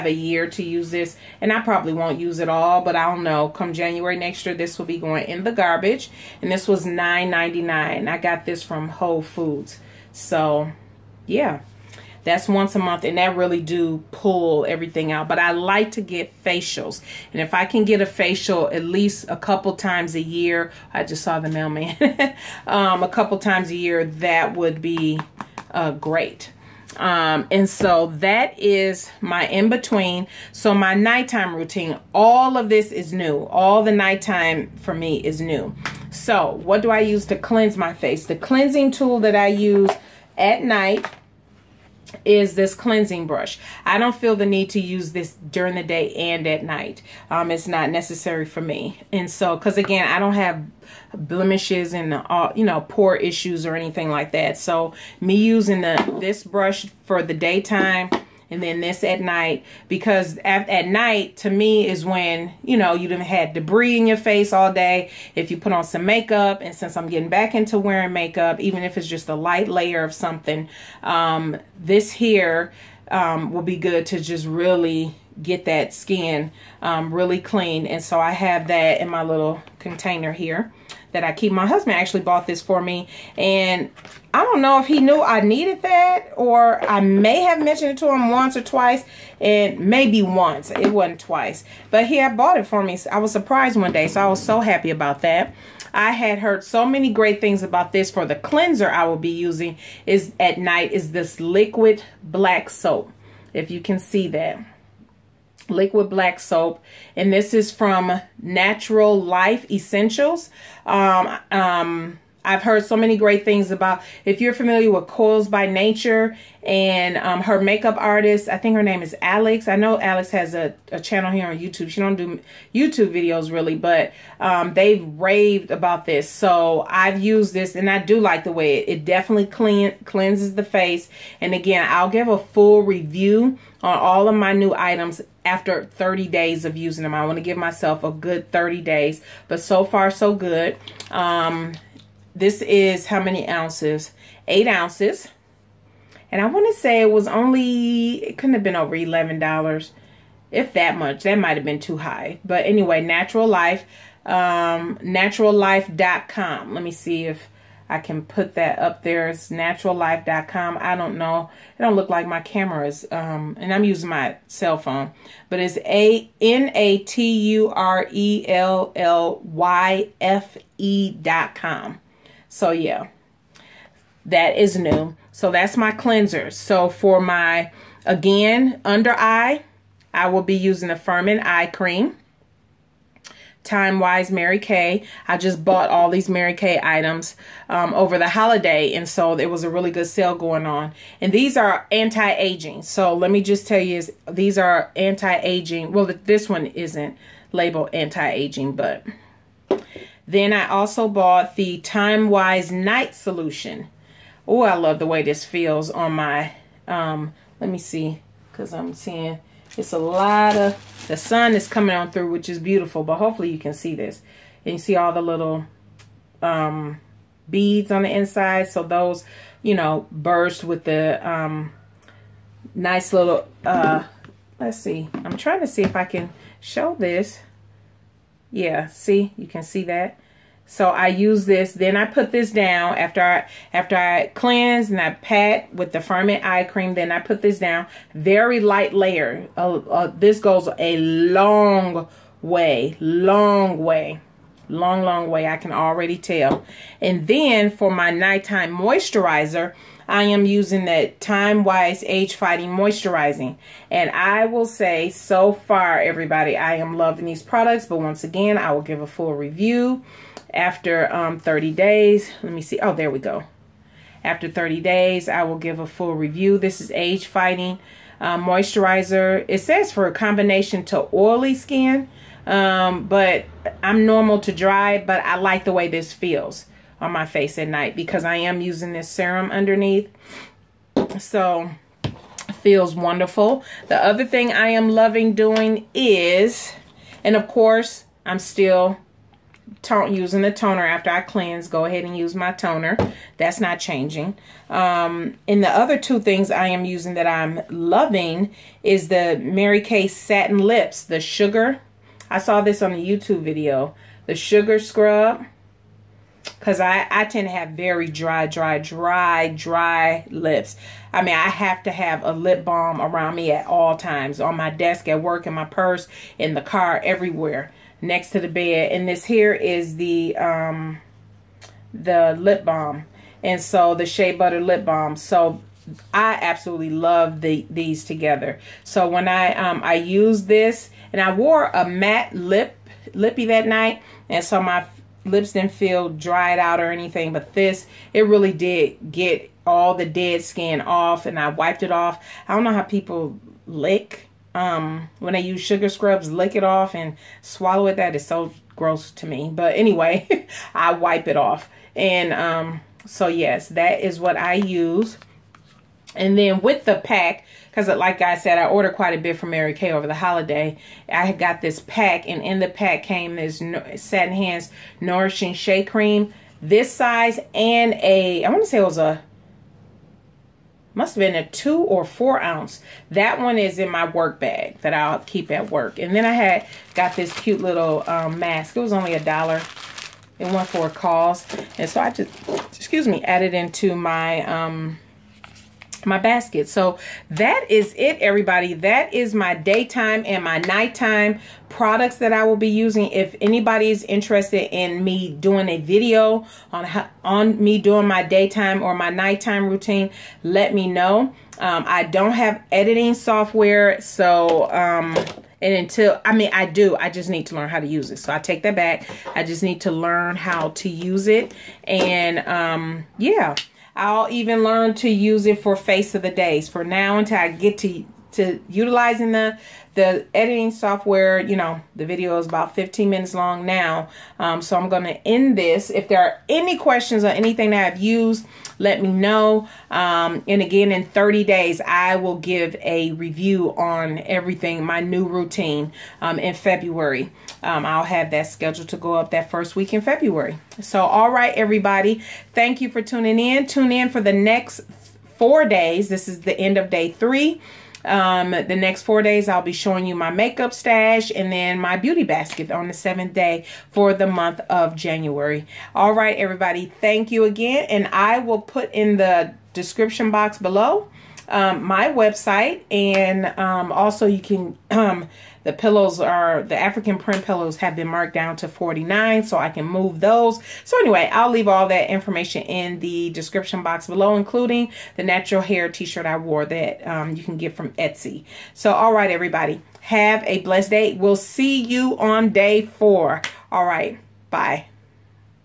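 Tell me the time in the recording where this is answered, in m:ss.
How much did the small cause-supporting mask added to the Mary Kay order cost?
6:19.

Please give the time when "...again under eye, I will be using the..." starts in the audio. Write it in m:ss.
2:58.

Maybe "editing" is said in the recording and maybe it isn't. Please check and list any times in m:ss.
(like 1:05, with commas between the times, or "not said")
6:42, 7:00.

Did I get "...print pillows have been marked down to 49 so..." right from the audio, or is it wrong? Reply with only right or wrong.
right.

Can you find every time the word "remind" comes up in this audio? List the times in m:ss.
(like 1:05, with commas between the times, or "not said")
not said.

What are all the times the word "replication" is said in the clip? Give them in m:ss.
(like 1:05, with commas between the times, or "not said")
not said.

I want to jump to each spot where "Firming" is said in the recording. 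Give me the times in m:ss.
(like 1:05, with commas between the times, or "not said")
3:00, 3:55.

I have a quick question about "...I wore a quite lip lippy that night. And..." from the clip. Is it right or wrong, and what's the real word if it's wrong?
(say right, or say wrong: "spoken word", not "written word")
wrong: "matte", not "quite".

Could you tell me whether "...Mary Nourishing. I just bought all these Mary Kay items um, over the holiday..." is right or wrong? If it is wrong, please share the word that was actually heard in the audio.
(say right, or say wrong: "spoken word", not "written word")
wrong: "Kay", not "Nourishing".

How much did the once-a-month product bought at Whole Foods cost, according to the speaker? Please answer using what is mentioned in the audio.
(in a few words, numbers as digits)
$9.99.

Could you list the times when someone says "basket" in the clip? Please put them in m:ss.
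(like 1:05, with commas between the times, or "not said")
6:26, 7:32.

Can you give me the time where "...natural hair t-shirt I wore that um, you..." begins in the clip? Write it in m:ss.
7:55.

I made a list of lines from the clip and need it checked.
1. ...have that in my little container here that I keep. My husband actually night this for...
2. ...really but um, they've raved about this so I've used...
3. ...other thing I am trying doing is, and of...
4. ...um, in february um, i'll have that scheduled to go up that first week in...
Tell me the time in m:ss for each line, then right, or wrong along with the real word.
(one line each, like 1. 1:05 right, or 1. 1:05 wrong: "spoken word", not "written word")
1. 1:18 wrong: "bought", not "night"
2. 2:03 right
3. 4:44 wrong: "loving", not "trying"
4. 7:16 right.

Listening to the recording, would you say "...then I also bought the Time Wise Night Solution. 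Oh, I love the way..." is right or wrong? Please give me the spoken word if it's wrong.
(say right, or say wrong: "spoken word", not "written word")
right.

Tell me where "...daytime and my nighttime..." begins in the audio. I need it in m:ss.
6:29.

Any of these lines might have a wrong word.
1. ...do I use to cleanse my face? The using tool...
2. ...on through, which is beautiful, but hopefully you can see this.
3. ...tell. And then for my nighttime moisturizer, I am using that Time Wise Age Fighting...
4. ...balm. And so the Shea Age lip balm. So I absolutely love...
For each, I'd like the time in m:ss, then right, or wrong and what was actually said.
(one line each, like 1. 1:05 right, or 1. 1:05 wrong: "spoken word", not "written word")
1. 0:36 wrong: "cleansing", not "using"
2. 3:31 right
3. 4:06 right
4. 5:22 wrong: "Butter", not "Age".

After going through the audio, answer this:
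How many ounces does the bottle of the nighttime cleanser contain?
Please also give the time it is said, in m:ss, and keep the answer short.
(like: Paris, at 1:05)
8, at 2:24.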